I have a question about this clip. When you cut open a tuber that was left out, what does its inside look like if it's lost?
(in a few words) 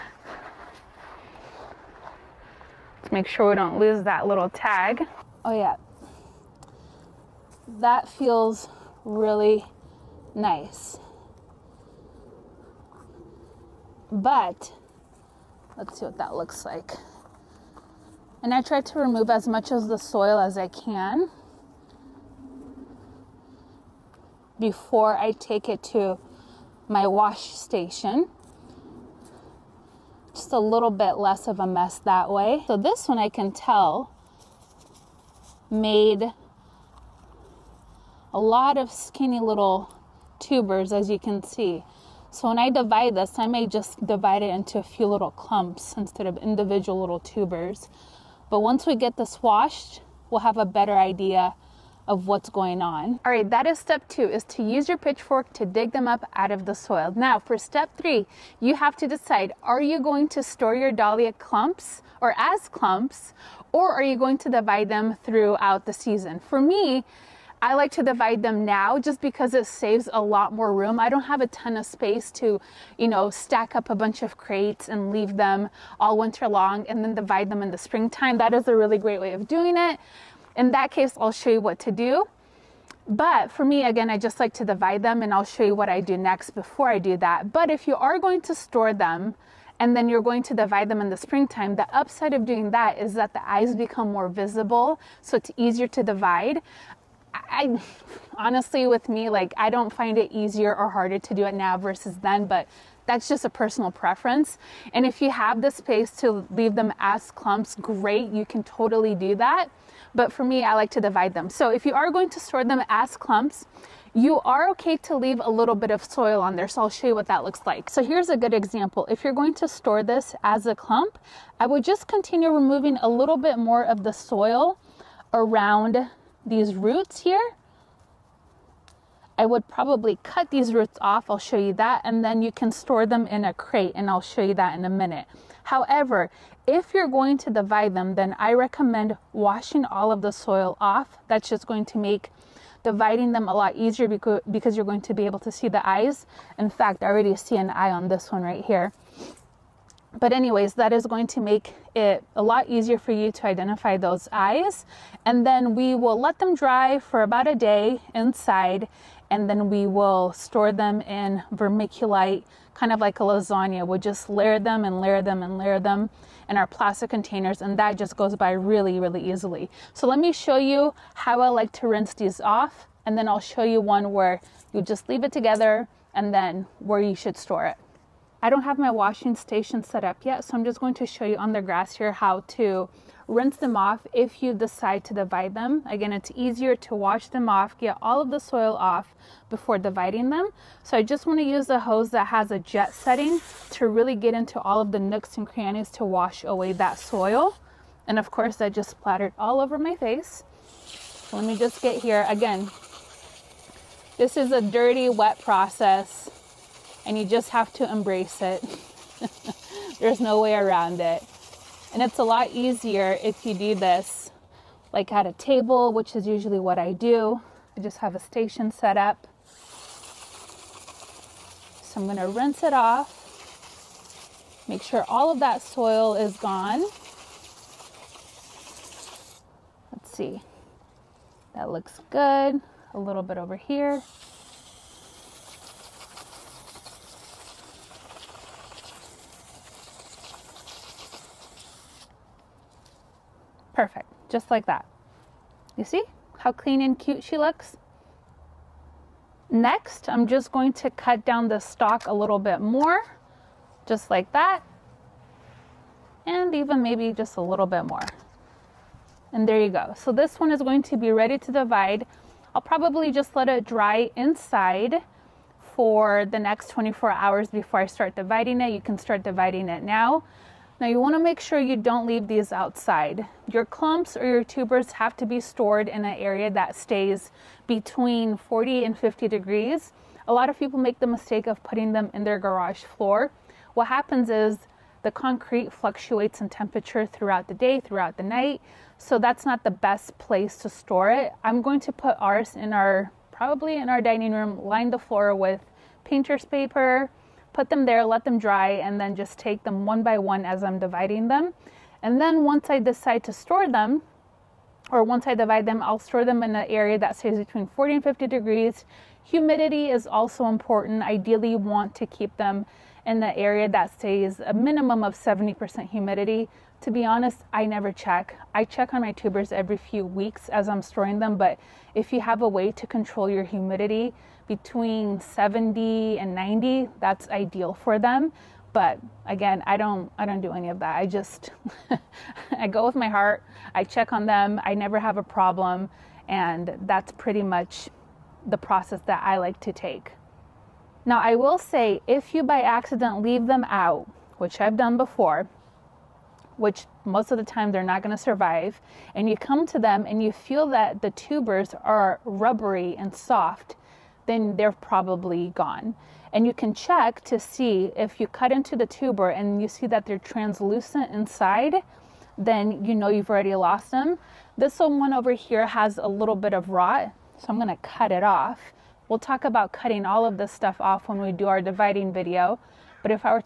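translucent.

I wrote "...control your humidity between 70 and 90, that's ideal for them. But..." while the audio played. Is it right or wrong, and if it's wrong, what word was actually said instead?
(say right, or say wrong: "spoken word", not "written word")
right.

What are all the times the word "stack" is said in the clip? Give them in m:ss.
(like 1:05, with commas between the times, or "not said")
1:13.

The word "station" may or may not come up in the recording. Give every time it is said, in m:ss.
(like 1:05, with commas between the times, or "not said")
0:27, 2:59, 3:38.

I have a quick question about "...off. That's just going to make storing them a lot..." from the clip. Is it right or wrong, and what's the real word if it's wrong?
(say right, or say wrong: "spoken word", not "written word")
wrong: "dividing", not "storing".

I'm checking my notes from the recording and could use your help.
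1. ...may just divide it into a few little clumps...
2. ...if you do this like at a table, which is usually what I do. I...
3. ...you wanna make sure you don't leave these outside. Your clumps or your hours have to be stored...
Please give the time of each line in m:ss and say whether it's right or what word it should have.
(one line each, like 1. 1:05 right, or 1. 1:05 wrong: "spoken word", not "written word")
1. 0:43 right
2. 3:33 right
3. 4:30 wrong: "tubers", not "hours".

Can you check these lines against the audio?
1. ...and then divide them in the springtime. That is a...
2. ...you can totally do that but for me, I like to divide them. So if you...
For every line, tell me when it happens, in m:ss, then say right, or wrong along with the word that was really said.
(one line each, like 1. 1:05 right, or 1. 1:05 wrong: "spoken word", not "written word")
1. 1:16 right
2. 1:48 right.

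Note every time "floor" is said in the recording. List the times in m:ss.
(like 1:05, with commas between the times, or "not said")
4:42, 4:54.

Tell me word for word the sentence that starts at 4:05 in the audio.
You see how clean and cute she looks?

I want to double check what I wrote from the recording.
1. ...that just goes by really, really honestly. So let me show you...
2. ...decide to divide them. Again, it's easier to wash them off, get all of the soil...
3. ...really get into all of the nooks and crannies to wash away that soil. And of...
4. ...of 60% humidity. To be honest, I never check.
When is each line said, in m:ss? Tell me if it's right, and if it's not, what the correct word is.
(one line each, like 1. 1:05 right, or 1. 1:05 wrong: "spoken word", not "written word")
1. 2:47 wrong: "easily", not "honestly"
2. 3:04 right
3. 3:13 right
4. 5:15 wrong: "70", not "60".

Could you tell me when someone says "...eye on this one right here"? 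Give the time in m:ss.
2:27.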